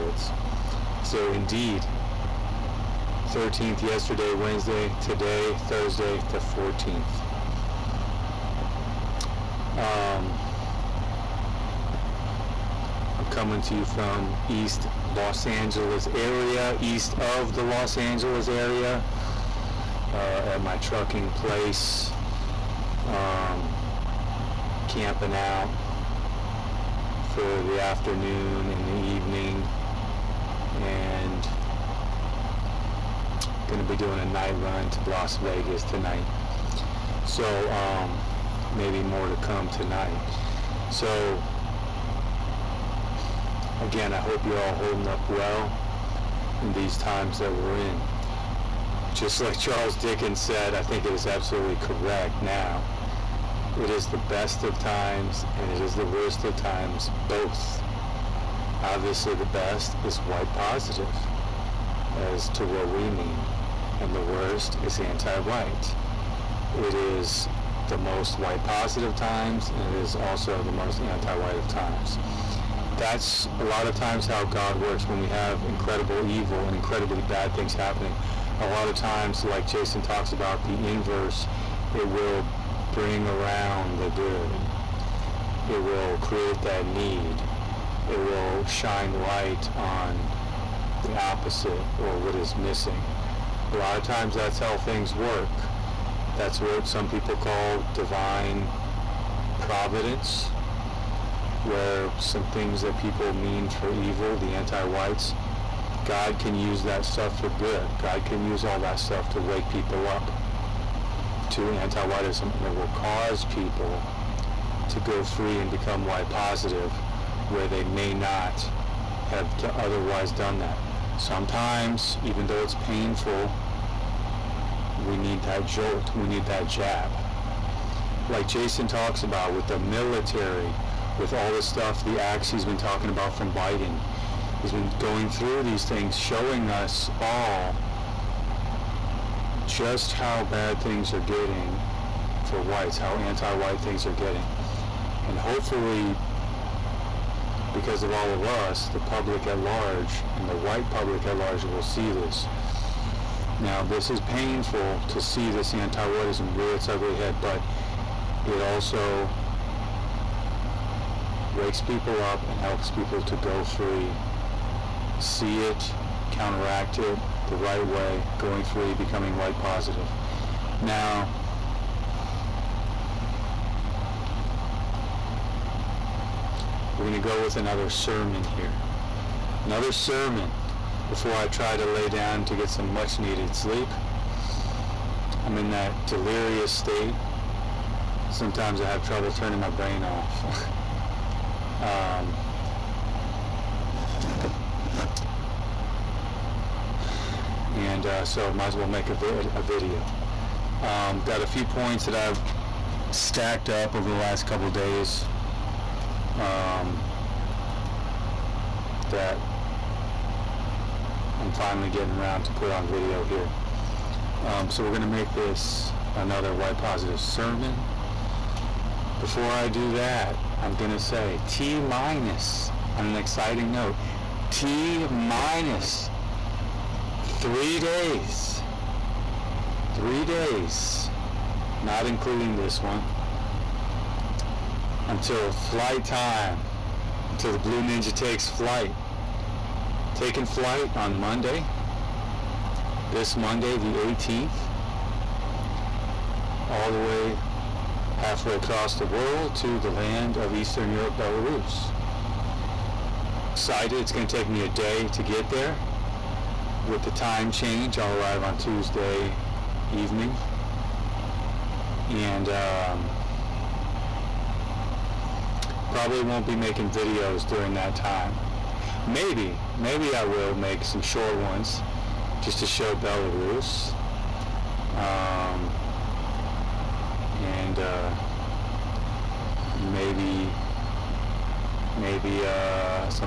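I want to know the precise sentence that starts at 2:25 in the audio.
And hopefully, because of all of us, the public at large and the white public at large will see this.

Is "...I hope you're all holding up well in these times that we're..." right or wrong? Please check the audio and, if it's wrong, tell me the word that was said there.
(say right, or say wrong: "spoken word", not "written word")
right.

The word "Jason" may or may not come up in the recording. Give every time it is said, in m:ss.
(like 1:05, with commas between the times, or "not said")
1:19, 2:08.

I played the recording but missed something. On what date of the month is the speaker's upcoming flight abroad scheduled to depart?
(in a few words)
18th.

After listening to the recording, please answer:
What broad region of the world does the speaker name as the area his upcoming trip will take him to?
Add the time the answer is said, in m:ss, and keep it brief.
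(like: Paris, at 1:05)
Eastern Europe, at 4:10.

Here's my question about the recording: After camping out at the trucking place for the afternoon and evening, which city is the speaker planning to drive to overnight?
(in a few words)
Las Vegas.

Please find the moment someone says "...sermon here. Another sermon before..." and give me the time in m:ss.
2:57.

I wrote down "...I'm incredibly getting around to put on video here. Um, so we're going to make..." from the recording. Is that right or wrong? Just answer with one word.
wrong.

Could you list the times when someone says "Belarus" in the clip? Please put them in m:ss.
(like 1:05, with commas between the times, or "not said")
4:11, 4:32.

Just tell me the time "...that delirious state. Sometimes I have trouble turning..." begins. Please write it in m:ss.
3:05.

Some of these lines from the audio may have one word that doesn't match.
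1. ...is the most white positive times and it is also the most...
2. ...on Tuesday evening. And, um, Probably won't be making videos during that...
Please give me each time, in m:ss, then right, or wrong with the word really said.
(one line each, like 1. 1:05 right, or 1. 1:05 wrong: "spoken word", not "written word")
1. 1:06 right
2. 4:18 right.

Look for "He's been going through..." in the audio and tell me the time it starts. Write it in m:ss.
2:14.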